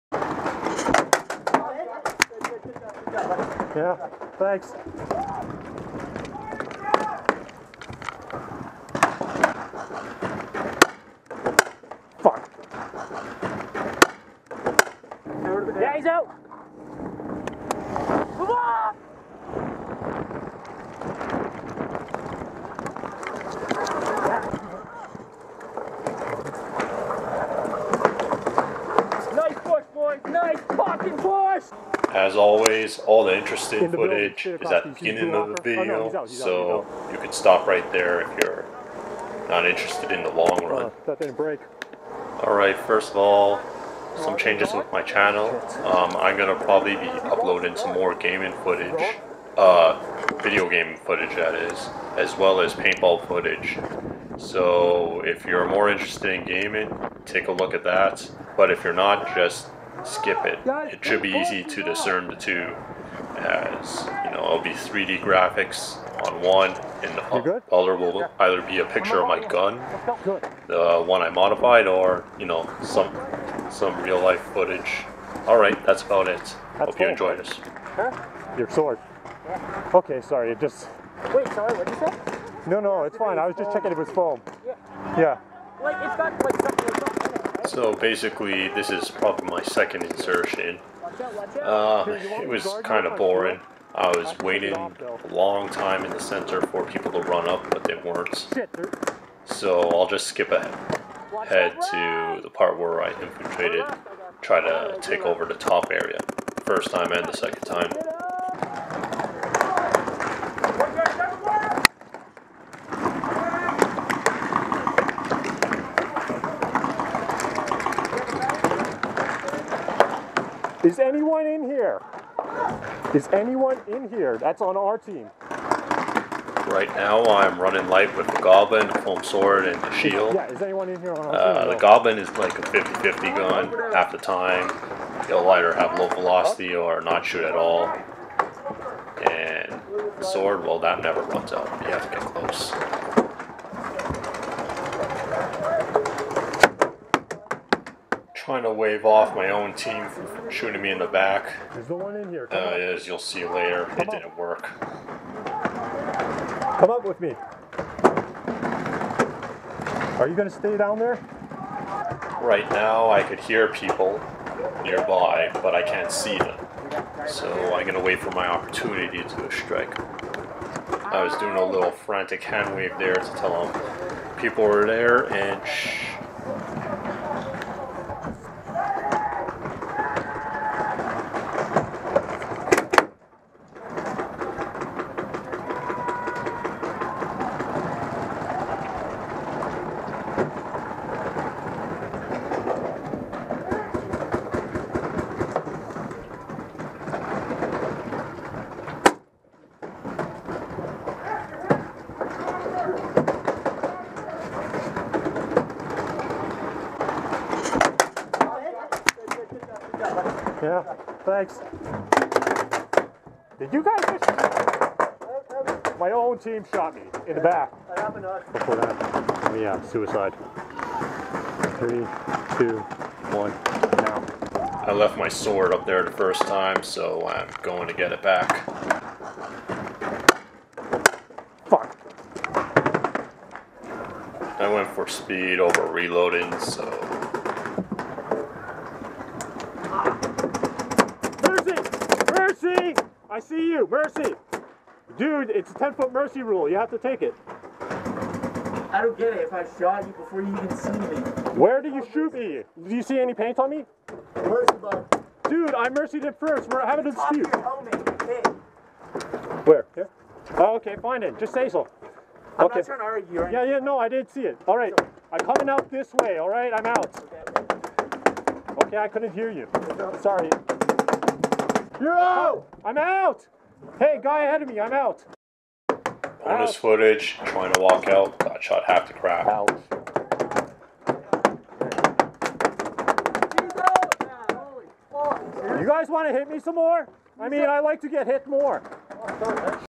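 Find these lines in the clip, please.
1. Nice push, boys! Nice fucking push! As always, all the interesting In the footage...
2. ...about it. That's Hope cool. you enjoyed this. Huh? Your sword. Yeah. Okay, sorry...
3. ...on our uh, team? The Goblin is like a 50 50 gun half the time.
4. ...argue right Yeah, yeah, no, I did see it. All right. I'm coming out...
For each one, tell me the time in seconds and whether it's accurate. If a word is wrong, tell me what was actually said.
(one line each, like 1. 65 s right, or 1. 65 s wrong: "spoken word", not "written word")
1. 29 s right
2. 76 s right
3. 131 s right
4. 263 s right.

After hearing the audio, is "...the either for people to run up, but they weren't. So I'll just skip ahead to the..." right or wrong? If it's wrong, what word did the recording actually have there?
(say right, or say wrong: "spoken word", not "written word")
wrong: "center", not "either".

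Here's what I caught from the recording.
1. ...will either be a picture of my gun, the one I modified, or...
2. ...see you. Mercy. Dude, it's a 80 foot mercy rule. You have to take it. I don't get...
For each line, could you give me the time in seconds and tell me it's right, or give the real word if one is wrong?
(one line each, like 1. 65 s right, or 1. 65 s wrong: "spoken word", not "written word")
1. 67 s right
2. 243 s wrong: "10", not "80".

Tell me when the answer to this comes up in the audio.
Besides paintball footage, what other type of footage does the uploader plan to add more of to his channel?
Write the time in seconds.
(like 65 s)
50 s.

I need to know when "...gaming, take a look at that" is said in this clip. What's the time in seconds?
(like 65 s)
56 s.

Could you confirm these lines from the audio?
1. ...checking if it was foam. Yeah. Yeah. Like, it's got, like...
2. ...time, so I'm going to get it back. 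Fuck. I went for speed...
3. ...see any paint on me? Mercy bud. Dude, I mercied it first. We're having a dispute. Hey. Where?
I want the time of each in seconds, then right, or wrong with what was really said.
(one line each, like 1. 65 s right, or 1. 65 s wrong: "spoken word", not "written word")
1. 83 s right
2. 226 s right
3. 253 s right.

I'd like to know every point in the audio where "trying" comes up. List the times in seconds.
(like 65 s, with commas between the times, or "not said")
148 s, 262 s, 277 s.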